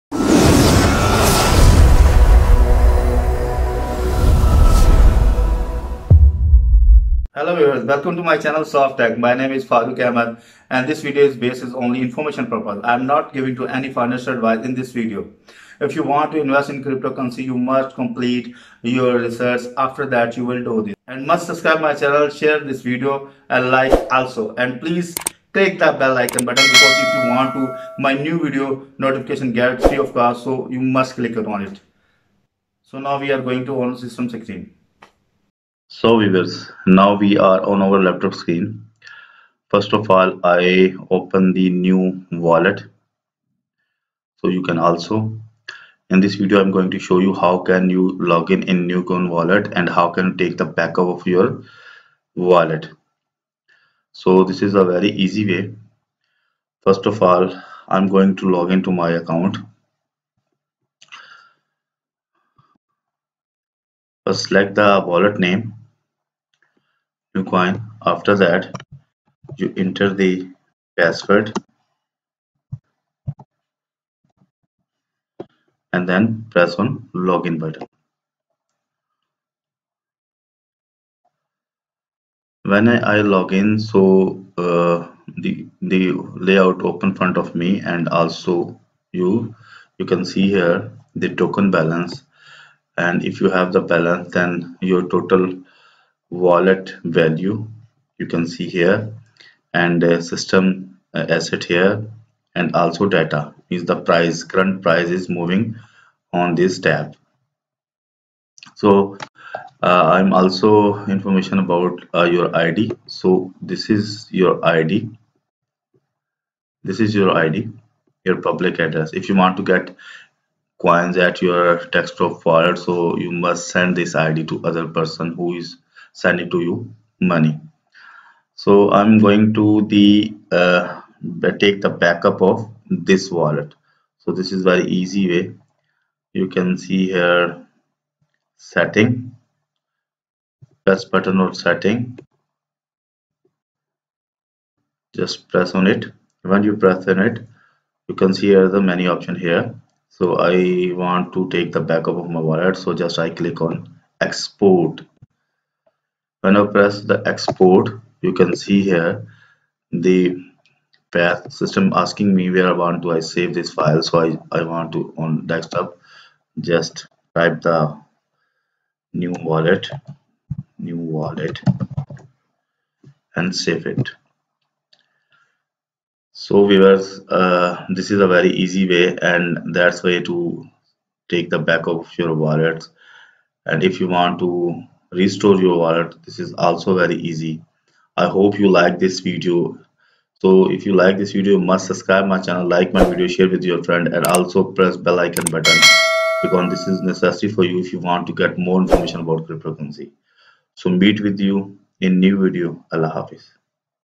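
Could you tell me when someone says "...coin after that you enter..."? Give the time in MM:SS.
01:07.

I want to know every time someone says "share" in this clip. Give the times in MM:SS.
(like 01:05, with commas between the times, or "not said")
00:22, 03:13.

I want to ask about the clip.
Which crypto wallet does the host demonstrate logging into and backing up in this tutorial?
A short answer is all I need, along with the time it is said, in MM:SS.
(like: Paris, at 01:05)
Neo coin wallet, at 00:48.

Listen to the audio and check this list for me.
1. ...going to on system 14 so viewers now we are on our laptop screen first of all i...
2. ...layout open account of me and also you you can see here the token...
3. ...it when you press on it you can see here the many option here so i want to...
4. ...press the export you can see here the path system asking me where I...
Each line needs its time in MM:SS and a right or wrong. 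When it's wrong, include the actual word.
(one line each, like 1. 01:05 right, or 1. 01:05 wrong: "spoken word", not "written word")
1. 00:33 wrong: "16", not "14"
2. 01:26 wrong: "front", not "account"
3. 02:25 right
4. 02:36 right.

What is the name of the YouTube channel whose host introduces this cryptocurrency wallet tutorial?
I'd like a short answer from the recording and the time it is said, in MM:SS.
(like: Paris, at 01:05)
Soft Tech, at 00:08.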